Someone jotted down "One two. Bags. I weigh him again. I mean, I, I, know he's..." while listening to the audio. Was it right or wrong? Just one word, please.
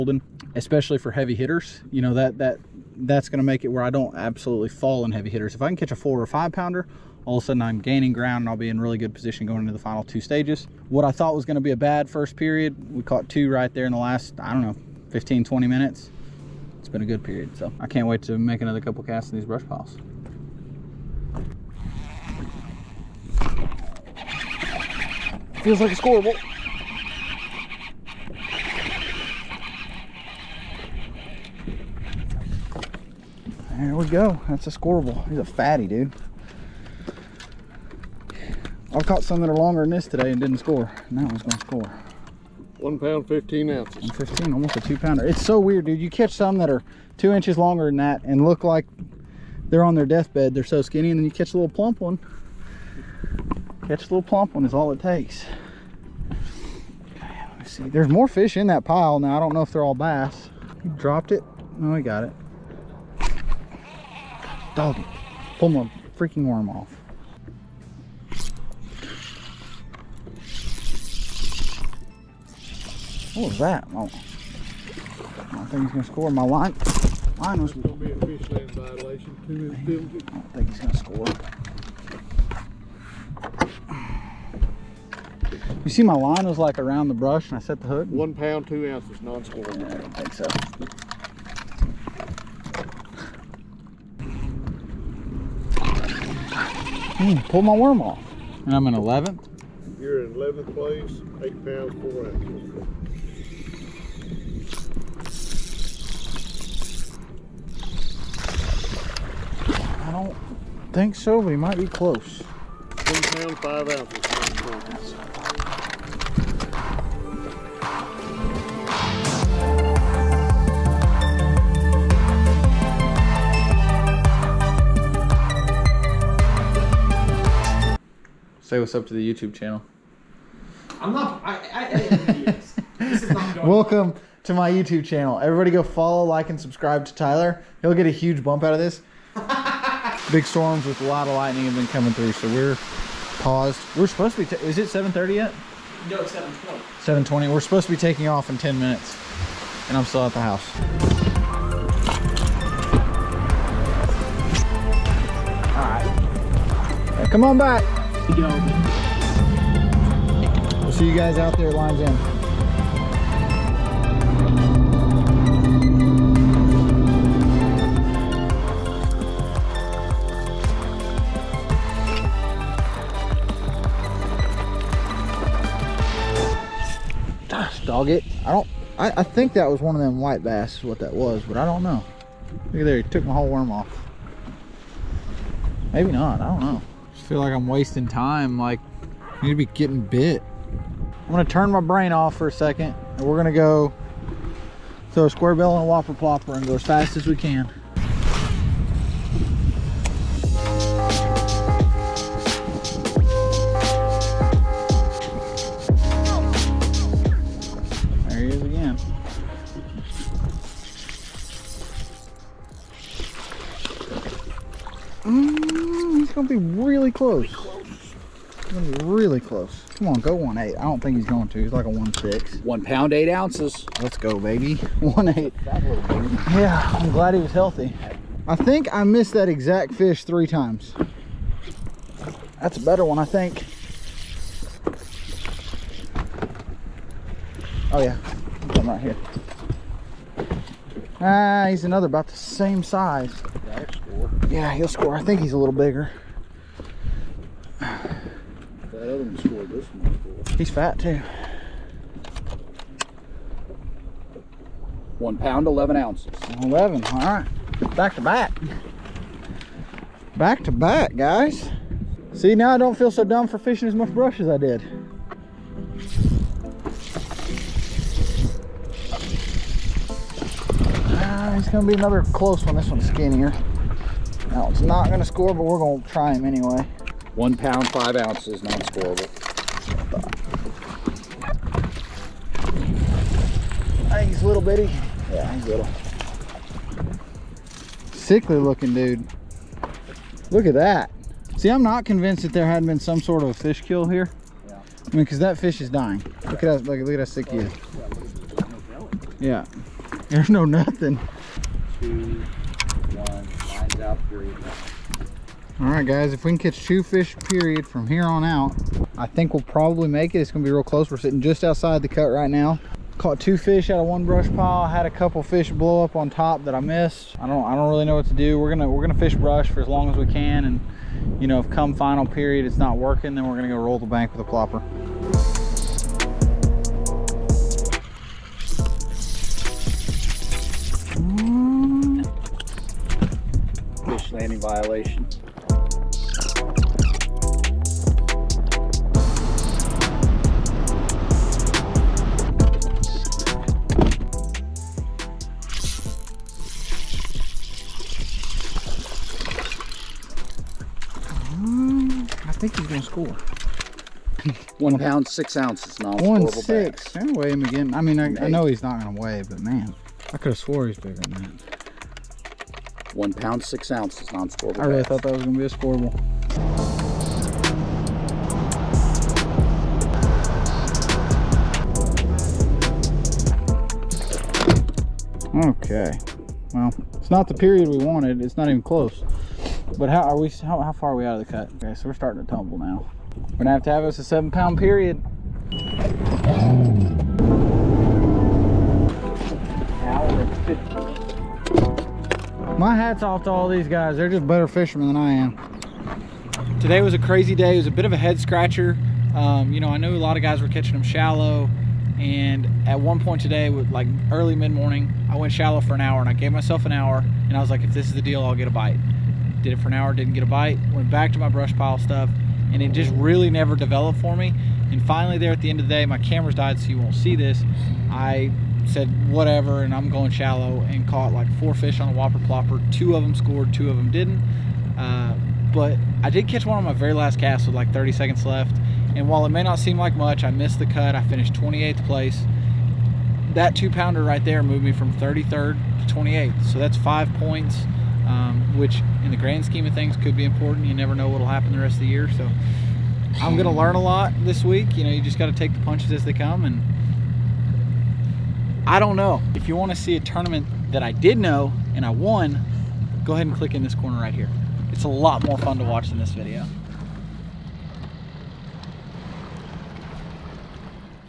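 wrong.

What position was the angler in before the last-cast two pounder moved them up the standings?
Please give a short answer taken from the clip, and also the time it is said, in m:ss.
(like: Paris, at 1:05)
33rd, at 7:15.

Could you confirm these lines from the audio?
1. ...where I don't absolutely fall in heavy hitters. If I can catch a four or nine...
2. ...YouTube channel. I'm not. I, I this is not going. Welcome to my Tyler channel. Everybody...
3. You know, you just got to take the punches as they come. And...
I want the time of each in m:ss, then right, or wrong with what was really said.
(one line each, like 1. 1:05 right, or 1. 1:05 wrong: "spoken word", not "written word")
1. 0:03 wrong: "five", not "nine"
2. 2:09 wrong: "YouTube", not "Tyler"
3. 7:24 right.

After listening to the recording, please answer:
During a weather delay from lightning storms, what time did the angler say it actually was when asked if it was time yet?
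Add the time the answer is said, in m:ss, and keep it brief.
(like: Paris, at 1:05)
7:20, at 2:26.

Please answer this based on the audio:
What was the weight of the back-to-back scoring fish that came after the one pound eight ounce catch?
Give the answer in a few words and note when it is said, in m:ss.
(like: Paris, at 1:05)
1 pound 11 ounces, at 4:15.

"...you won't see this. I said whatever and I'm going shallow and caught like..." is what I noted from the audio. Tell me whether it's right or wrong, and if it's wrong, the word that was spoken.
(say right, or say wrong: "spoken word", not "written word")
right.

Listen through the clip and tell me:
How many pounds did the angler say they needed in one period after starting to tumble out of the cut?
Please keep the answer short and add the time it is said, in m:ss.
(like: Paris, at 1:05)
7, at 6:24.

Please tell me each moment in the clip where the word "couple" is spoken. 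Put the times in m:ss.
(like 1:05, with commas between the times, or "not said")
0:18, 5:15.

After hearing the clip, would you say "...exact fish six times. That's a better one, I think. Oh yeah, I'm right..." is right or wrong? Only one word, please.
wrong.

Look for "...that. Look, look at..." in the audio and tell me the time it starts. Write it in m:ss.
4:56.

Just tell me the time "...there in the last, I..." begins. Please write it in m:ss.
0:13.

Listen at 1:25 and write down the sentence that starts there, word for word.
You see, my line was like around the brush, and I set the hook.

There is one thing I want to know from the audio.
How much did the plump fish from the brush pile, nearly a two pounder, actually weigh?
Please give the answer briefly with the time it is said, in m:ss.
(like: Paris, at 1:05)
1 pound 15 ounces, at 0:42.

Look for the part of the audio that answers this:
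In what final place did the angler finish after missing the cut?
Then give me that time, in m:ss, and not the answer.
7:11.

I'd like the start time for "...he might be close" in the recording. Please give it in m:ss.
1:51.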